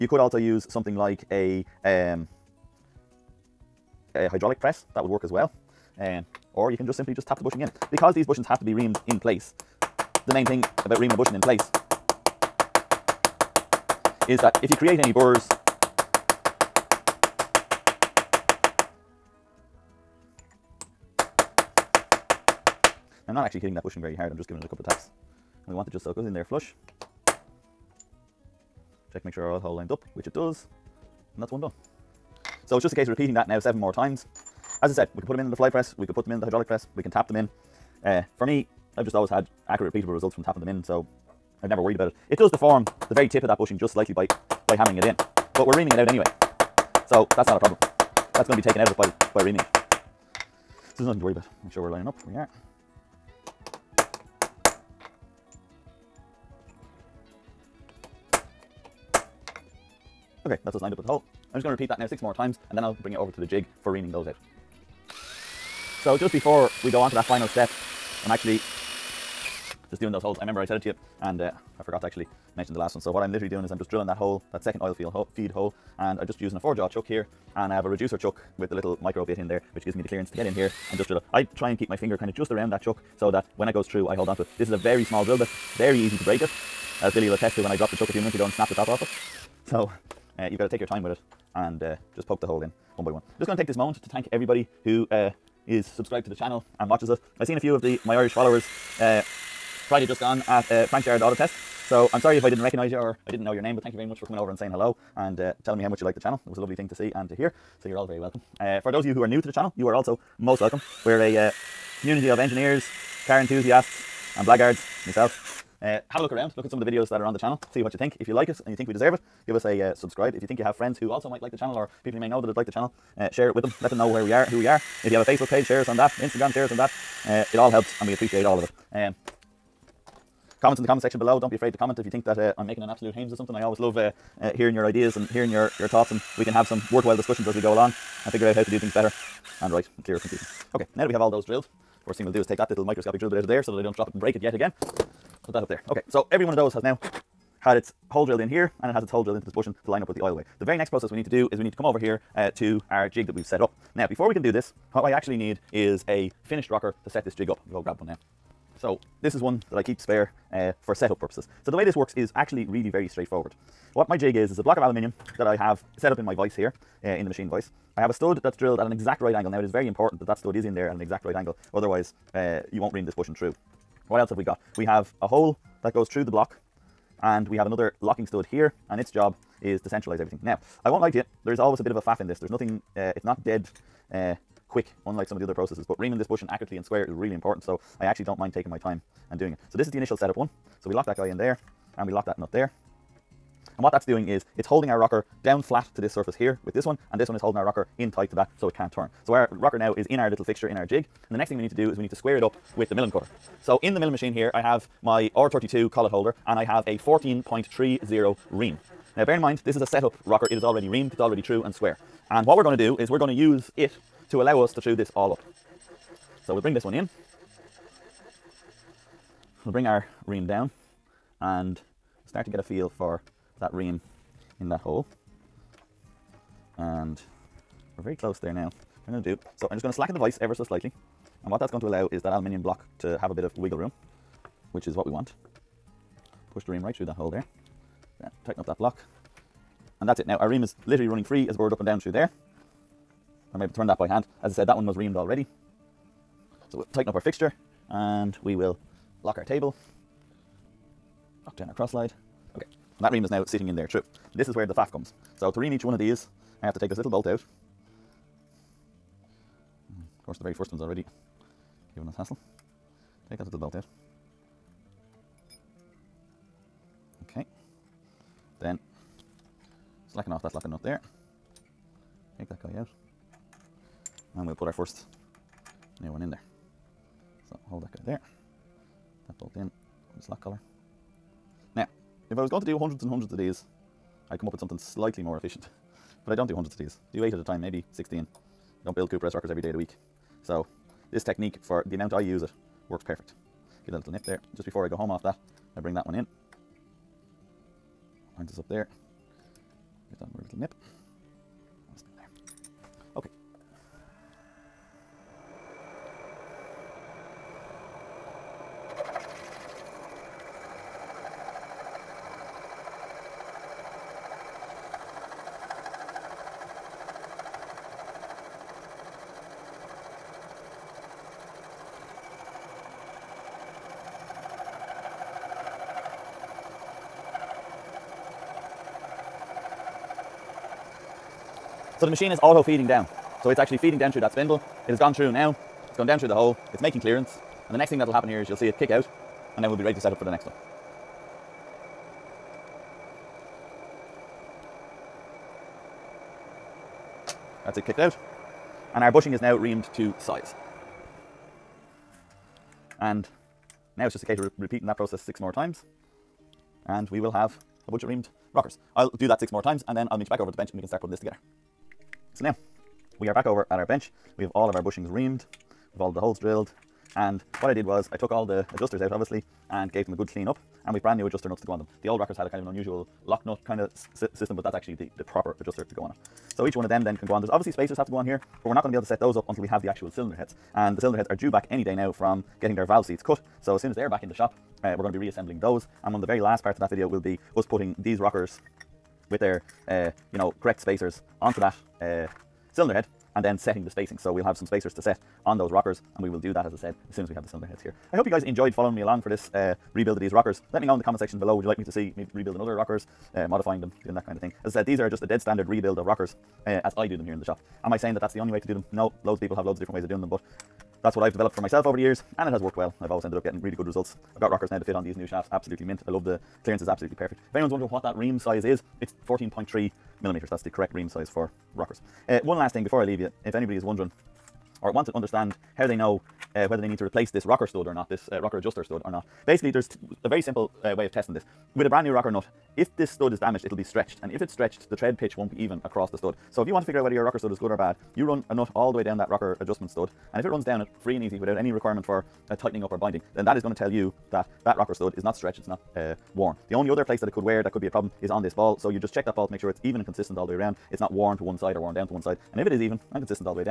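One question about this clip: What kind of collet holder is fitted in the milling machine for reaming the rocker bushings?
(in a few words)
R32.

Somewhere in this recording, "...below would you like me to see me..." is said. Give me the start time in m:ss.
6:41.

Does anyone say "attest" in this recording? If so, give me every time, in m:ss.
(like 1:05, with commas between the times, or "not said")
1:27.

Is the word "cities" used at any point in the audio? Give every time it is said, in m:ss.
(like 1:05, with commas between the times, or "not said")
not said.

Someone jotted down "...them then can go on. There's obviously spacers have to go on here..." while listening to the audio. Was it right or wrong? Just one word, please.
right.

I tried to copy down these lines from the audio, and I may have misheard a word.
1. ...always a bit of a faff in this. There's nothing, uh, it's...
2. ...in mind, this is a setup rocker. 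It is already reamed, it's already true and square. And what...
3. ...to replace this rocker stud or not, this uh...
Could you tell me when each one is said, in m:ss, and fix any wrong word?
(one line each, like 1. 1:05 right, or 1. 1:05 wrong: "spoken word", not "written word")
1. 3:01 right
2. 3:29 right
3. 7:06 right.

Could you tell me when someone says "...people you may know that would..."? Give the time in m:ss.
2:02.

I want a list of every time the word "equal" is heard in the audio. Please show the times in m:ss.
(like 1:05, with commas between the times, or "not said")
not said.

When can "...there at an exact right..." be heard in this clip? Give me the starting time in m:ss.
2:50.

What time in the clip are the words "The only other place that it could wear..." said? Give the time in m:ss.
7:26.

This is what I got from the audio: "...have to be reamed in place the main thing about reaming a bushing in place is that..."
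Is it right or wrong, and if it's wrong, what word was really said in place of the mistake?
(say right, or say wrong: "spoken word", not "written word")
right.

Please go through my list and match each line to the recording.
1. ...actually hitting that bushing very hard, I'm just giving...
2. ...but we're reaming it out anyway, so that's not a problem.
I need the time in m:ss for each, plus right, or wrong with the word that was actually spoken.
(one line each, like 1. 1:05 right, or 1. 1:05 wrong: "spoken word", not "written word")
1. 0:23 right
2. 0:45 right.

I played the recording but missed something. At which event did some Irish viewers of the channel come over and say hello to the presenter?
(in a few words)
Frank Sherrod Auto Test.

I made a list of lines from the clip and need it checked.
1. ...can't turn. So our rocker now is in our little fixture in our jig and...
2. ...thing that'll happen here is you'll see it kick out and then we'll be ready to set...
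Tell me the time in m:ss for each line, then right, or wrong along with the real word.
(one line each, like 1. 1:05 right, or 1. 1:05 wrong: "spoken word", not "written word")
1. 3:18 right
2. 5:37 right.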